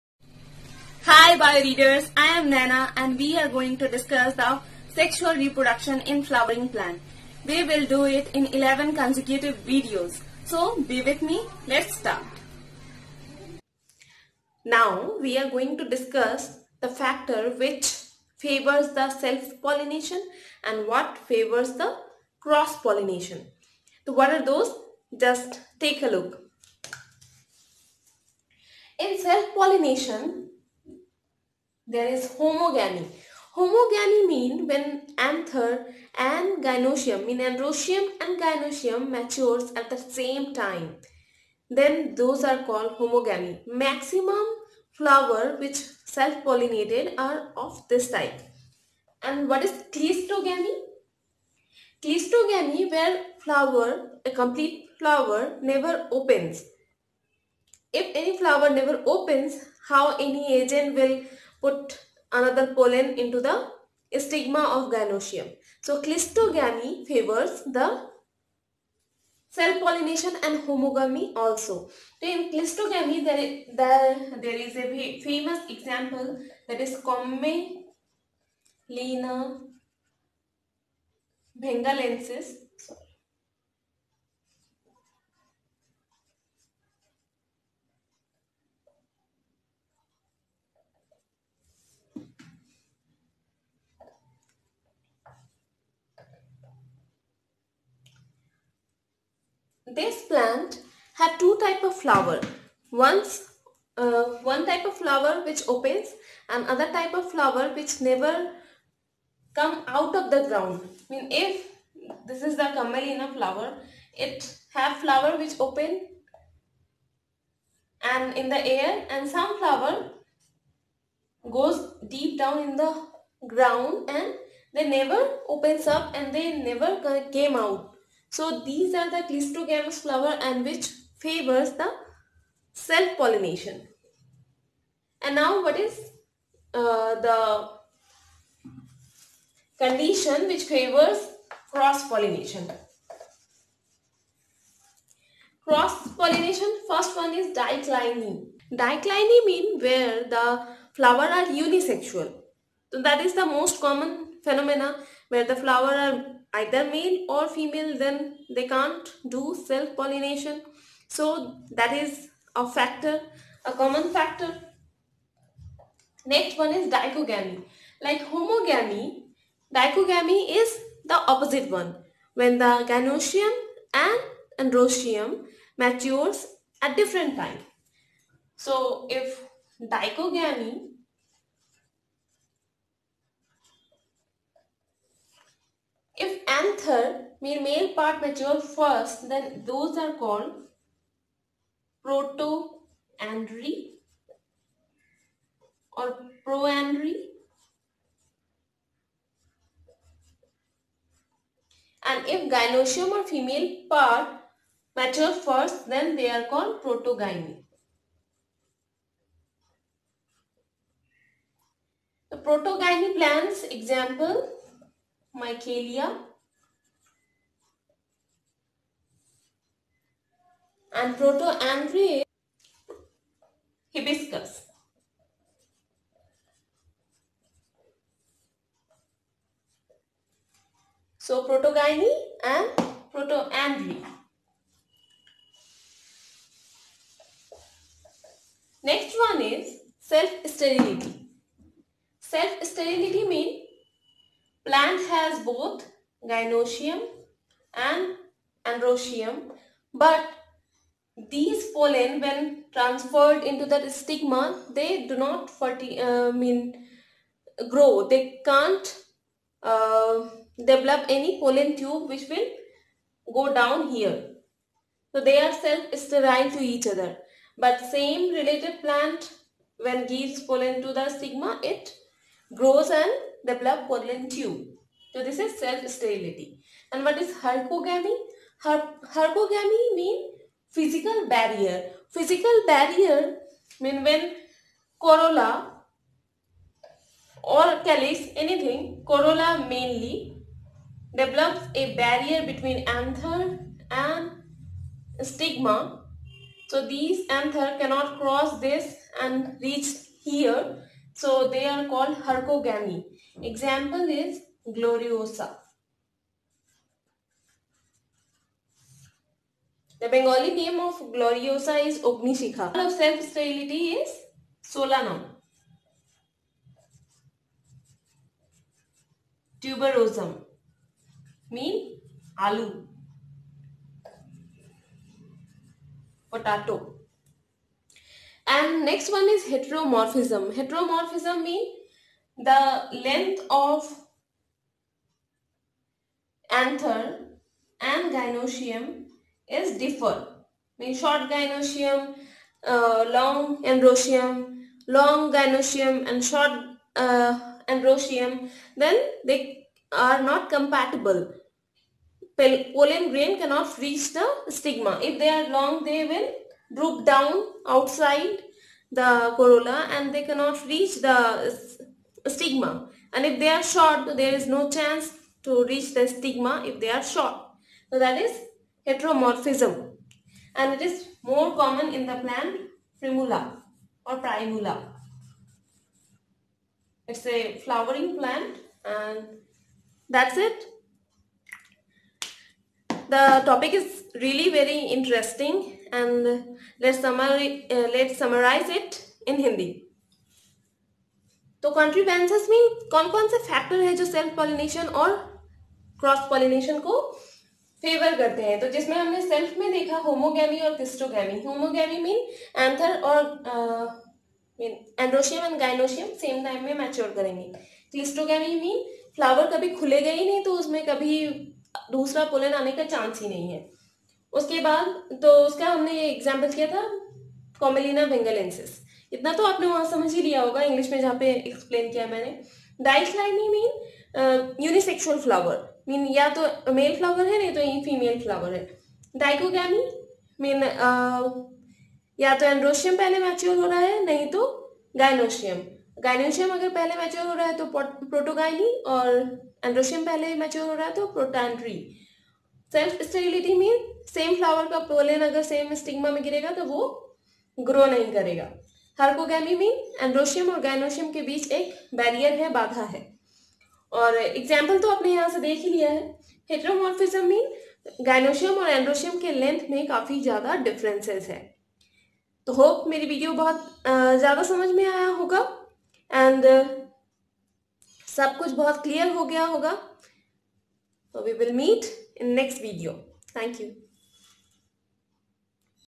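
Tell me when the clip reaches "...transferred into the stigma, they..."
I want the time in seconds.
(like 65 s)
252 s.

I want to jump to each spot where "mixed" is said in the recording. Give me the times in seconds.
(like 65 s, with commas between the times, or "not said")
not said.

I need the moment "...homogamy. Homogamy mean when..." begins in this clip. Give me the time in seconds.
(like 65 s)
32 s.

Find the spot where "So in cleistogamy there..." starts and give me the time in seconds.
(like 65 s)
72 s.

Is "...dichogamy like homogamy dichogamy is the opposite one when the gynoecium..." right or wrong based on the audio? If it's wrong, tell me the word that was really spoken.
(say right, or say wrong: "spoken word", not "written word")
right.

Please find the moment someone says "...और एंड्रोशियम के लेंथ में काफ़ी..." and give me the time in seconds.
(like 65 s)
458 s.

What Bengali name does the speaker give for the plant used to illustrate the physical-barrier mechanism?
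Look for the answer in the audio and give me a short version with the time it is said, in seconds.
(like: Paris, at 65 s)
Ognishikha, at 312 s.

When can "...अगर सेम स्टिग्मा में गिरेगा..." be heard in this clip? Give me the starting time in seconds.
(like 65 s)
445 s.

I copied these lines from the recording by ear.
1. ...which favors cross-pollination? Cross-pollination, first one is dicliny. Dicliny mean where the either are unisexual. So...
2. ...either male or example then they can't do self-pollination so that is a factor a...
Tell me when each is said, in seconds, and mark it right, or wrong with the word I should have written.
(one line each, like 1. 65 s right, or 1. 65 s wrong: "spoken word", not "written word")
1. 140 s wrong: "flower", not "either"
2. 156 s wrong: "female", not "example".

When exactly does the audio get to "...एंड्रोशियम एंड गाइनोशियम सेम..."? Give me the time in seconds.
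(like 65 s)
405 s.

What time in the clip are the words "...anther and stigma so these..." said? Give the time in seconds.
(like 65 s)
292 s.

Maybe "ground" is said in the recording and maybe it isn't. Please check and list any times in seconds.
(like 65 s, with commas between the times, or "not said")
110 s, 123 s.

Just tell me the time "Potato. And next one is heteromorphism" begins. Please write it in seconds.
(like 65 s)
326 s.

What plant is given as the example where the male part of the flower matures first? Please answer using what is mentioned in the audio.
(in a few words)
Hibiscus.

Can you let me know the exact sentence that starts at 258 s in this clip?
They can't uh, develop any pollen tube which will go down here.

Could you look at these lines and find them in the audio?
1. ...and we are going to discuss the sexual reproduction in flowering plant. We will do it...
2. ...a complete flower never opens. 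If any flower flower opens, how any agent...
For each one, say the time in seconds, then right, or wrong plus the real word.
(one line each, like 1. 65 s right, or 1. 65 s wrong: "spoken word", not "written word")
1. 2 s right
2. 54 s wrong: "never", not "flower".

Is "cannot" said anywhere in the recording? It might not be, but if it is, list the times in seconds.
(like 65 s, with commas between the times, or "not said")
297 s, 353 s, 360 s.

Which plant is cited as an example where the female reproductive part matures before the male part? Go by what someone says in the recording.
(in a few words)
Michelia.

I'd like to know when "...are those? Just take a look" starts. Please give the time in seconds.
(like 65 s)
24 s.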